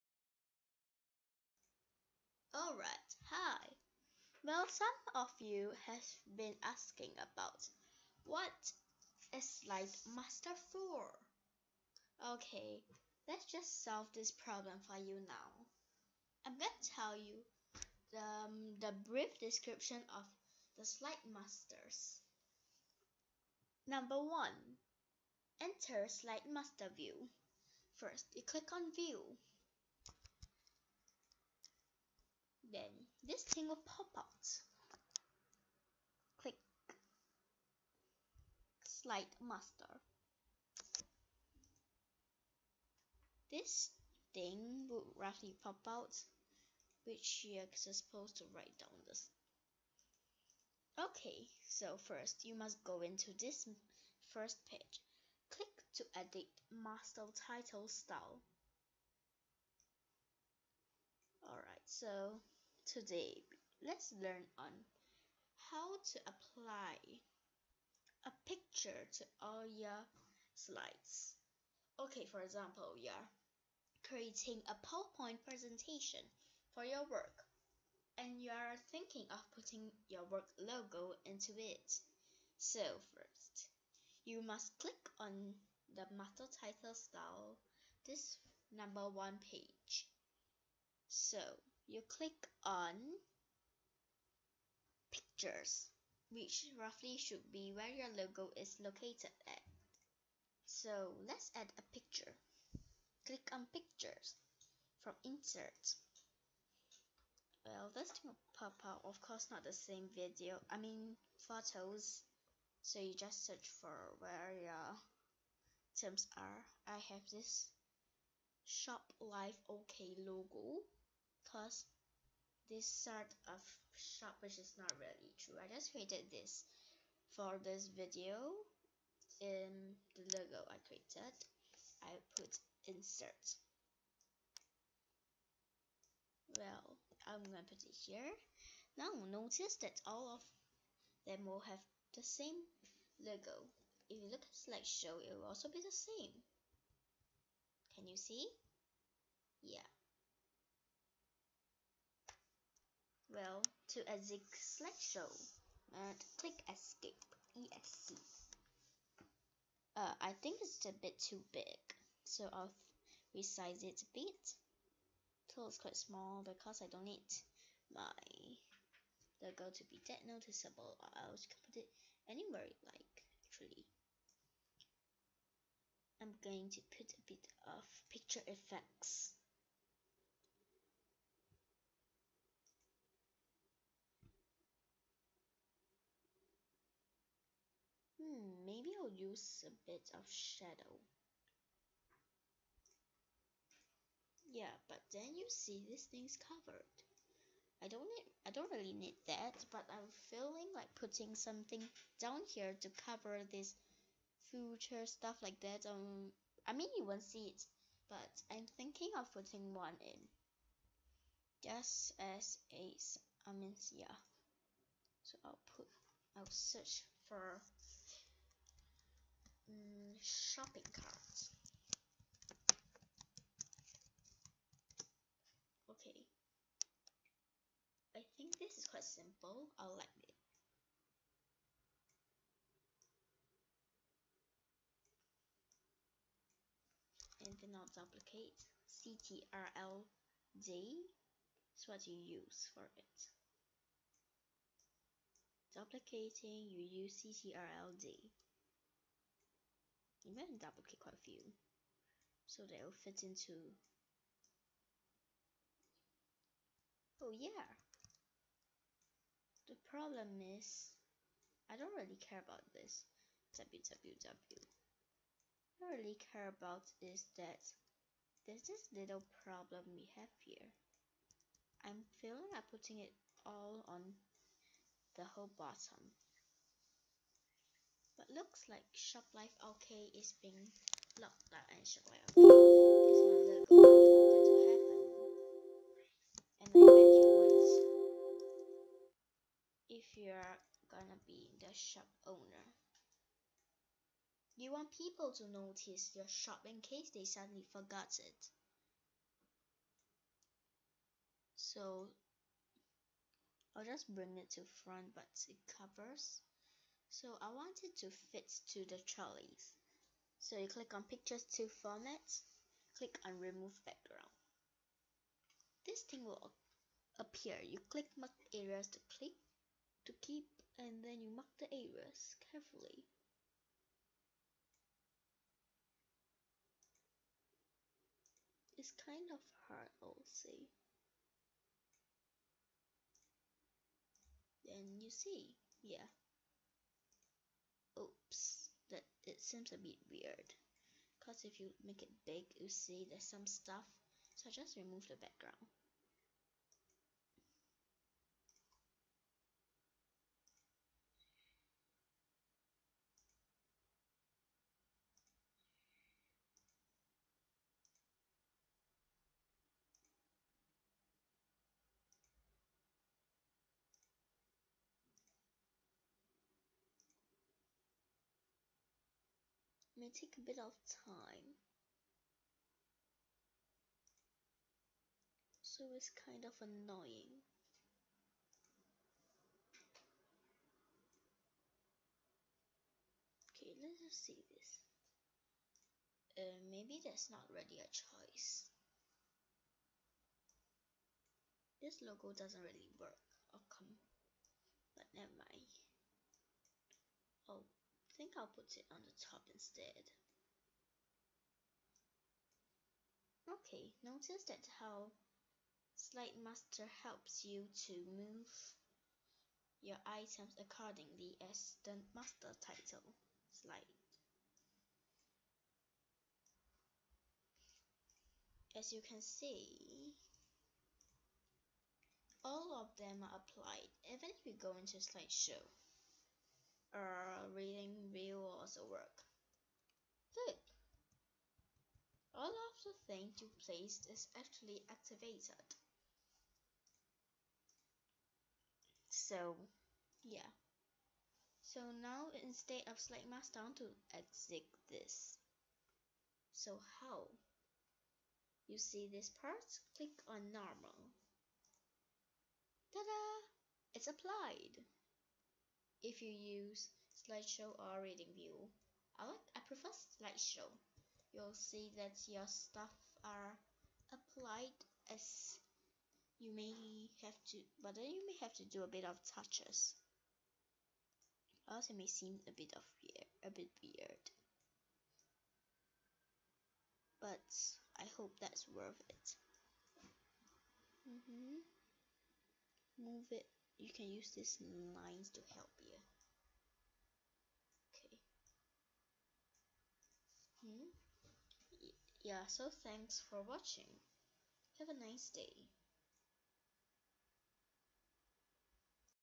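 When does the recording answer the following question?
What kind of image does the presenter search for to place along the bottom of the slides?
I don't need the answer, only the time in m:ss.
3:40.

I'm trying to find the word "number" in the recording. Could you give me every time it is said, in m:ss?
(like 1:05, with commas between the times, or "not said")
0:23, 1:28.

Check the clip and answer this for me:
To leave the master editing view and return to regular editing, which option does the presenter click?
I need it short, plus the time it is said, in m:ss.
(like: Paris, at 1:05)
Normal, at 7:30.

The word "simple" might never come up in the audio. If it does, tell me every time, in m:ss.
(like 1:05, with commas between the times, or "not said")
3:49.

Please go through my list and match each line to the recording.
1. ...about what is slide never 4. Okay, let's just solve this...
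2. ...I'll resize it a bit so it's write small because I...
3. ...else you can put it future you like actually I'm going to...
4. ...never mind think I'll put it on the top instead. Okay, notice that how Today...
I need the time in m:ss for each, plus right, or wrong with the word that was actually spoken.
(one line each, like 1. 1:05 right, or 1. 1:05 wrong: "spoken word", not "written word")
1. 0:07 wrong: "master", not "never"
2. 2:42 wrong: "quite", not "write"
3. 2:51 wrong: "anywhere", not "future"
4. 6:35 wrong: "Slide", not "Today".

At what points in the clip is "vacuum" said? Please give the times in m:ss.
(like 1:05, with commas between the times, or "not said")
not said.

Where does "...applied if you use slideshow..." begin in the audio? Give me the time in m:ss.
7:34.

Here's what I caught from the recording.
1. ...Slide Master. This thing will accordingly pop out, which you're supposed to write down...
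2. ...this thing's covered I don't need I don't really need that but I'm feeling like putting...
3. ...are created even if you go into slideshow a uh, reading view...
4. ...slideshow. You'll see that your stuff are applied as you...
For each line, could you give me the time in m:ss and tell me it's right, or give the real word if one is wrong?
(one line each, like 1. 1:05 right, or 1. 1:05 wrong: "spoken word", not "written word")
1. 0:38 wrong: "roughly", not "accordingly"
2. 3:15 right
3. 7:03 wrong: "applied", not "created"
4. 7:40 right.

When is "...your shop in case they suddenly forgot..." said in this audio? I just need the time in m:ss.
4:56.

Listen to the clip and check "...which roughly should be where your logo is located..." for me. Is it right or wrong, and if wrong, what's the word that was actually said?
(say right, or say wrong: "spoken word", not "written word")
right.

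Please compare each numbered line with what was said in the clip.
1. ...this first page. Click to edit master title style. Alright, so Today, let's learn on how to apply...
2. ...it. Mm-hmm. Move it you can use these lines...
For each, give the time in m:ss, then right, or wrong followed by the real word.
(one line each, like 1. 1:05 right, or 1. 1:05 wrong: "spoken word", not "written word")
1. 0:53 right
2. 7:59 right.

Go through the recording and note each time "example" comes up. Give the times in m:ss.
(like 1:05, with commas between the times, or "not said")
1:12.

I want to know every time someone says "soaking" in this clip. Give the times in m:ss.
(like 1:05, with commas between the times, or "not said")
not said.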